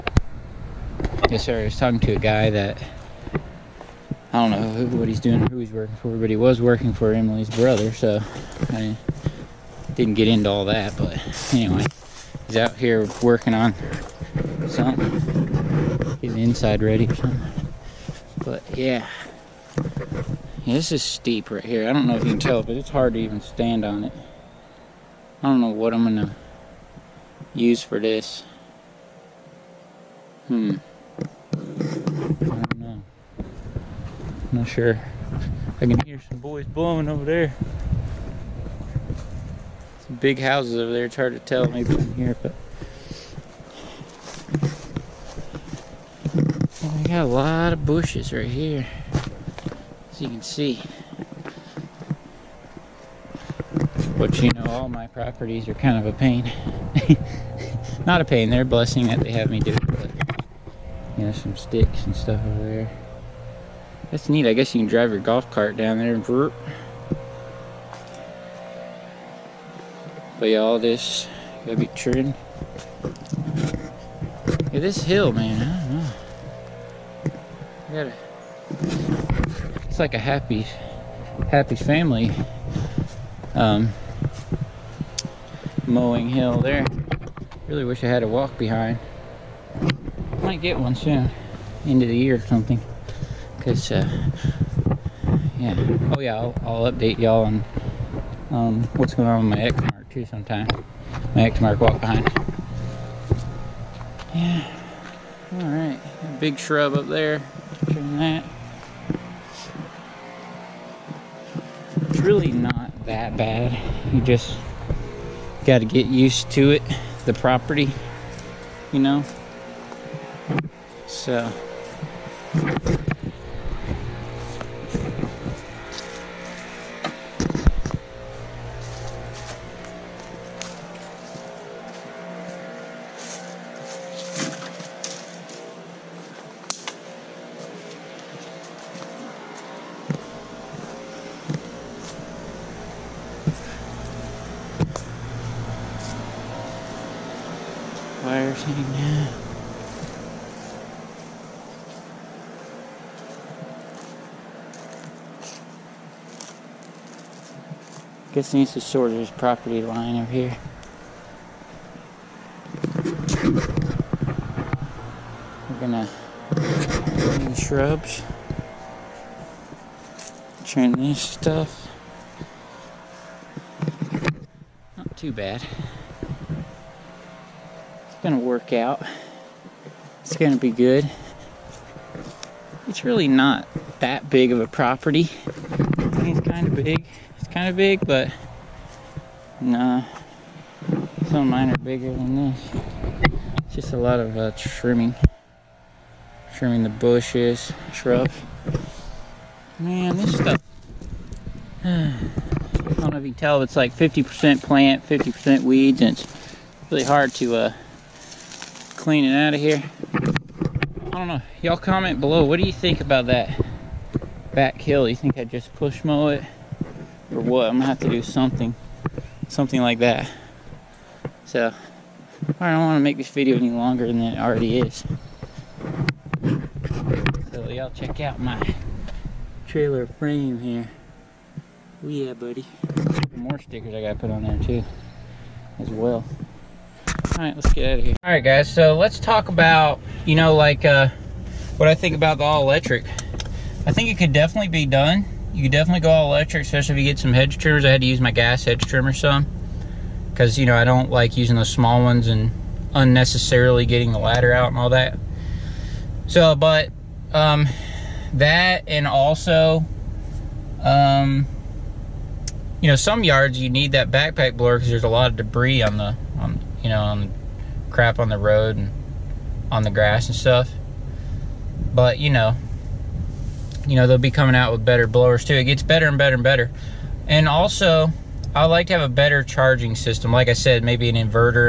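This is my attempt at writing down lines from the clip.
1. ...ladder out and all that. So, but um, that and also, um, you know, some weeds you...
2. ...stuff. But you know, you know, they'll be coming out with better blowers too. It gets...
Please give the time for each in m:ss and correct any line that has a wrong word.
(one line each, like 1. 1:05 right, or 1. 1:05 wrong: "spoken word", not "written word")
1. 4:14 wrong: "yards", not "weeds"
2. 4:30 right.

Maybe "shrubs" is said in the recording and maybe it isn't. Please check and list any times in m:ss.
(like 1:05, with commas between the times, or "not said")
1:46, 2:47, 3:17.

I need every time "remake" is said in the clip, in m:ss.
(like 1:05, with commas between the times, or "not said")
not said.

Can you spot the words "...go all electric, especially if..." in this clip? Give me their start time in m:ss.
4:06.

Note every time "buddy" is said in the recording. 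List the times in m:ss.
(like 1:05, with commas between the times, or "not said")
3:52.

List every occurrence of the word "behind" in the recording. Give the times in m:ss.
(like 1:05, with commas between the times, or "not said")
1:28, 1:42.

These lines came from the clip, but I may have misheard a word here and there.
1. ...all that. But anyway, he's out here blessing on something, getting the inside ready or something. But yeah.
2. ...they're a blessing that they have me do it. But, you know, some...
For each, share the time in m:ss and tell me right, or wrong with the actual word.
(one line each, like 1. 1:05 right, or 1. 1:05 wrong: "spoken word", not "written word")
1. 0:10 wrong: "working", not "blessing"
2. 0:58 right.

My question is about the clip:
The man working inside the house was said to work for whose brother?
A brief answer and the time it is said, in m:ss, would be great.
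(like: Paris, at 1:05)
Emily, at 0:07.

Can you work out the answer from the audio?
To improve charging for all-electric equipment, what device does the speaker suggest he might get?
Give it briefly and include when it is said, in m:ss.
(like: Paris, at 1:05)
an inverter, at 4:41.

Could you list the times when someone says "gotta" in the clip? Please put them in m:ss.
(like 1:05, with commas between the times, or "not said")
1:11, 1:18, 3:54.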